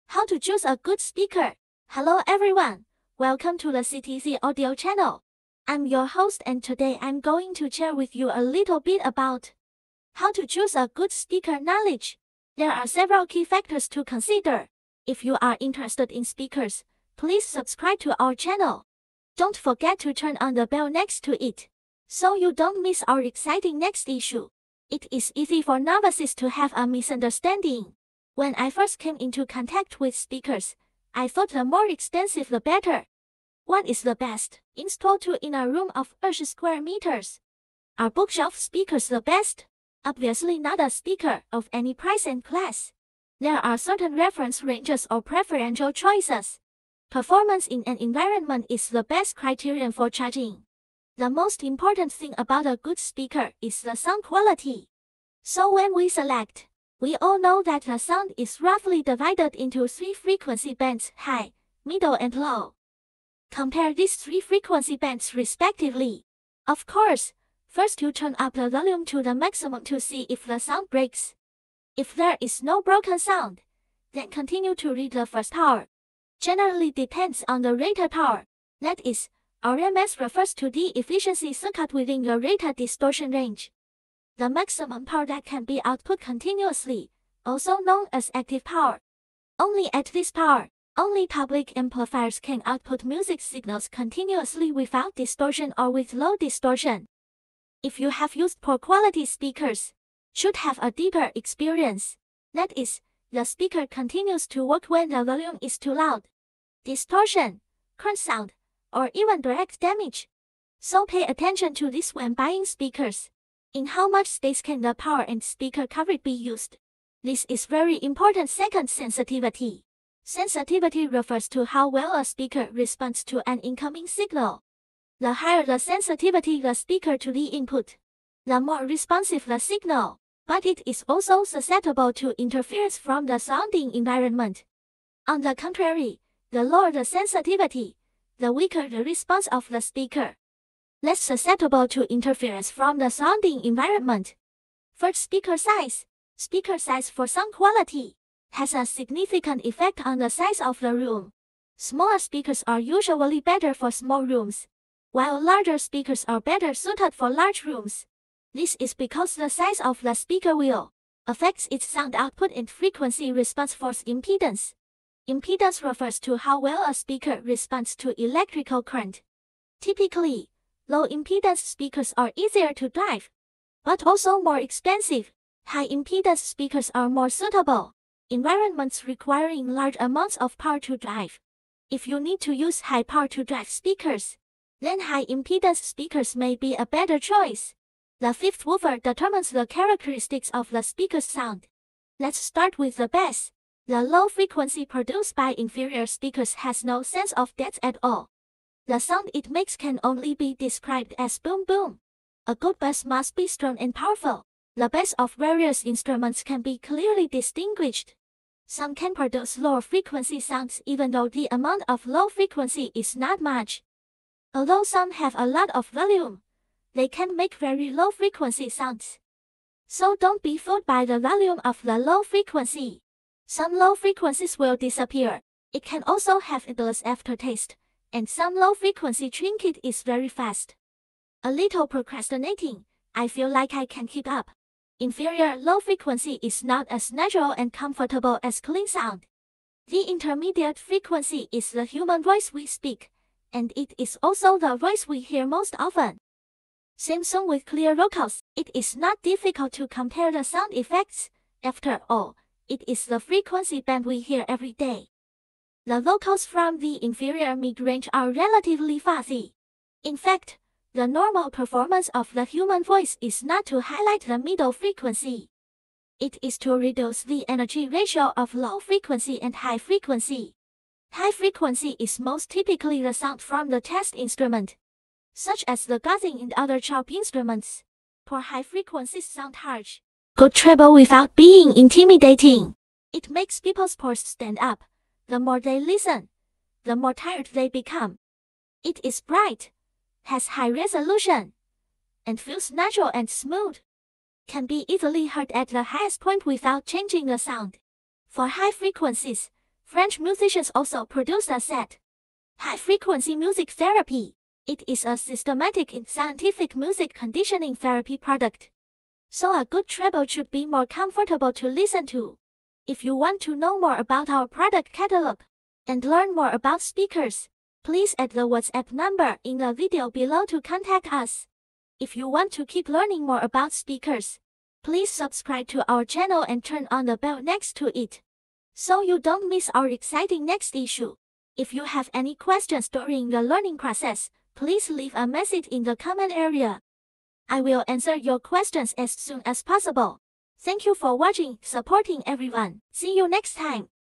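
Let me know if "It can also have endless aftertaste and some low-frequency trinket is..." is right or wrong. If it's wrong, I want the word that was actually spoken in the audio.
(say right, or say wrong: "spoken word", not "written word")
right.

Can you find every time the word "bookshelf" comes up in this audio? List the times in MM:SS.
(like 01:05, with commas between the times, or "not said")
00:38.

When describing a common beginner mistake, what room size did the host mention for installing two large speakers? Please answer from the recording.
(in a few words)
20 square meters.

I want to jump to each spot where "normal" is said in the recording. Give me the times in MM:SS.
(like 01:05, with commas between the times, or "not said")
04:21.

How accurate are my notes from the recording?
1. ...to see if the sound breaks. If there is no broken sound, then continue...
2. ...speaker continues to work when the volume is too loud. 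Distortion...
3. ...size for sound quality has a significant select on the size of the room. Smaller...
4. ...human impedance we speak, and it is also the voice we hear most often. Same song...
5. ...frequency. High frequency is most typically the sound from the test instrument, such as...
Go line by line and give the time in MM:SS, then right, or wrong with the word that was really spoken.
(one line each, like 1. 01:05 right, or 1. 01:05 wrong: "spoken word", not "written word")
1. 01:09 right
2. 01:43 right
3. 02:26 wrong: "effect", not "select"
4. 04:01 wrong: "voice", not "impedance"
5. 04:29 right.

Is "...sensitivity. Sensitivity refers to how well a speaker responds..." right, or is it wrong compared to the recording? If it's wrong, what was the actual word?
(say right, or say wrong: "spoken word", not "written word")
right.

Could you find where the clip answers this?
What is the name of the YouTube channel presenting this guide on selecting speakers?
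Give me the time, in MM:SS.
00:03.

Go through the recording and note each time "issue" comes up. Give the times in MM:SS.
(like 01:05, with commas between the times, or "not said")
00:24, 05:30.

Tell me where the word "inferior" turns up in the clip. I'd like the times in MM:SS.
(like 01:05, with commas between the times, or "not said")
03:15, 03:54, 04:17.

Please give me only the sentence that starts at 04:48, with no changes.
It is bright, has high resolution, and feels natural and smooth.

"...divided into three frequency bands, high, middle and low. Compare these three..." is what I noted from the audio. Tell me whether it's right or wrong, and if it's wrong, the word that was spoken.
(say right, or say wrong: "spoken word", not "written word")
right.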